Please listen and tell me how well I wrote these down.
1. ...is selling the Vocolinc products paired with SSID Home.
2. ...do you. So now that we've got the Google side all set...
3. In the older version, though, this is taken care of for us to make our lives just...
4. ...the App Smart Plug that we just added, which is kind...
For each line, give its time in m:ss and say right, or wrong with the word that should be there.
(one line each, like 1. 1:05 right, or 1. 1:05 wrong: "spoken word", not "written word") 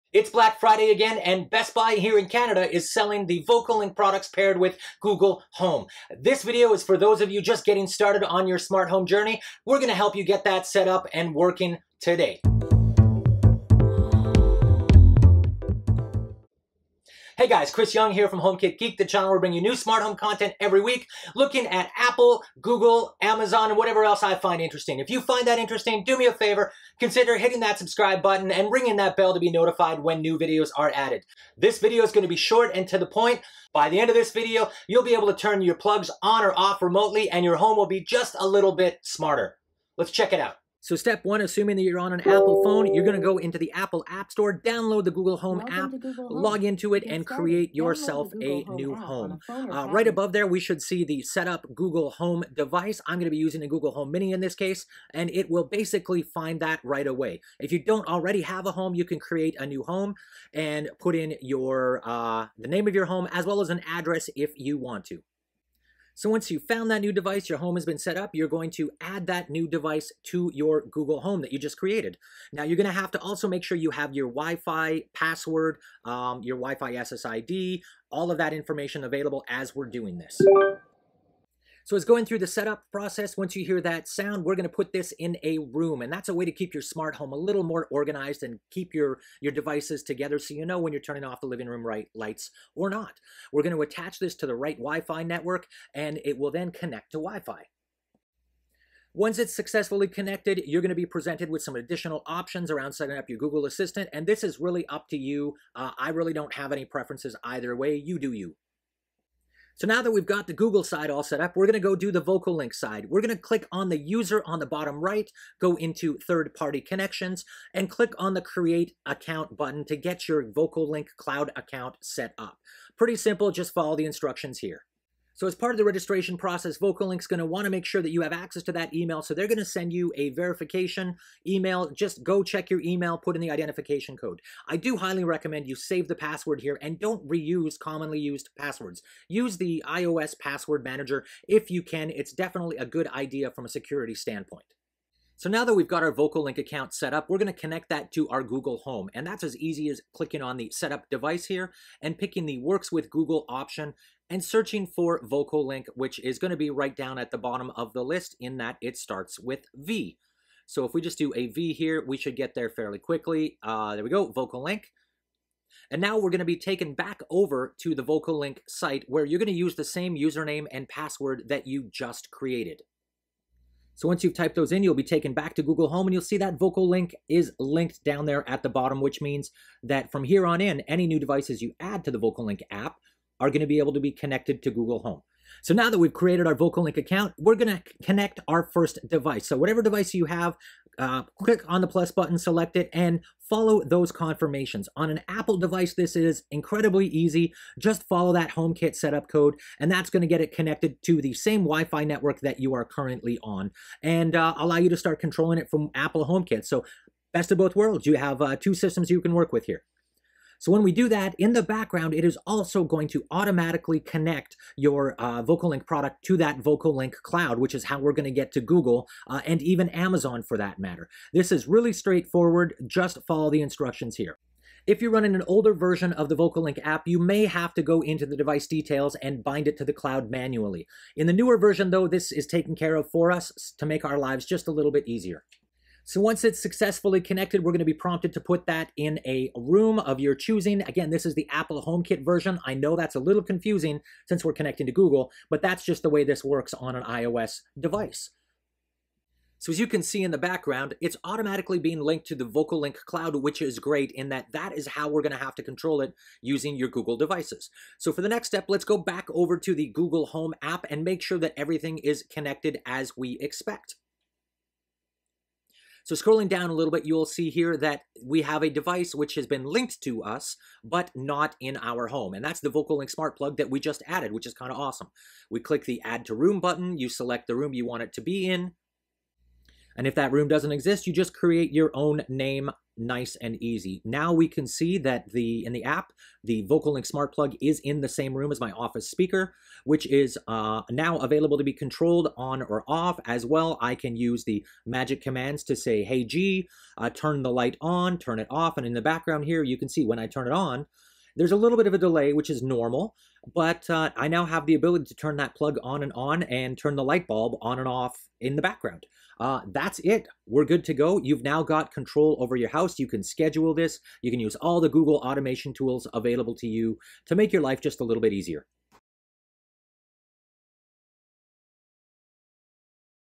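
1. 0:02 wrong: "Google", not "SSID"
2. 1:48 right
3. 3:51 wrong: "newer", not "older"
4. 4:32 wrong: "Vocolinc", not "App".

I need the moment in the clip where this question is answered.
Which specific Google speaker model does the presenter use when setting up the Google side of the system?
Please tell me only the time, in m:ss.
0:53.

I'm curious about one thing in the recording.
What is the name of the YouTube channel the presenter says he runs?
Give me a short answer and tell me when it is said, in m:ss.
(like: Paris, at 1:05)
HomeKit Geek, at 0:18.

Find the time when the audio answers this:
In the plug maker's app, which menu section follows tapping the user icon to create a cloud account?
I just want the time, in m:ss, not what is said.
1:56.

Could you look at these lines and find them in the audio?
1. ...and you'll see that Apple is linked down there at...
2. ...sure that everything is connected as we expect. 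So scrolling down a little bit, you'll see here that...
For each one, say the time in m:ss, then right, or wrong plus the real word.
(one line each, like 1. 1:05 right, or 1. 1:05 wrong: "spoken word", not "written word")
1. 2:56 wrong: "Vocolinc", not "Apple"
2. 4:21 right.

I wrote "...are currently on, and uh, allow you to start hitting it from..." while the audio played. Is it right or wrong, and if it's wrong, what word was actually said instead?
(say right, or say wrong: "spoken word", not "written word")
wrong: "controlling", not "hitting".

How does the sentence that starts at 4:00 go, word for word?
Again, this is the Apple HomeKit version.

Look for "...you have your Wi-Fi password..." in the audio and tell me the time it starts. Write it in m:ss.
1:13.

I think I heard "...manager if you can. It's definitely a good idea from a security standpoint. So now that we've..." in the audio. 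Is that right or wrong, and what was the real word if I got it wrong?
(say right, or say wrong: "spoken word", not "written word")
right.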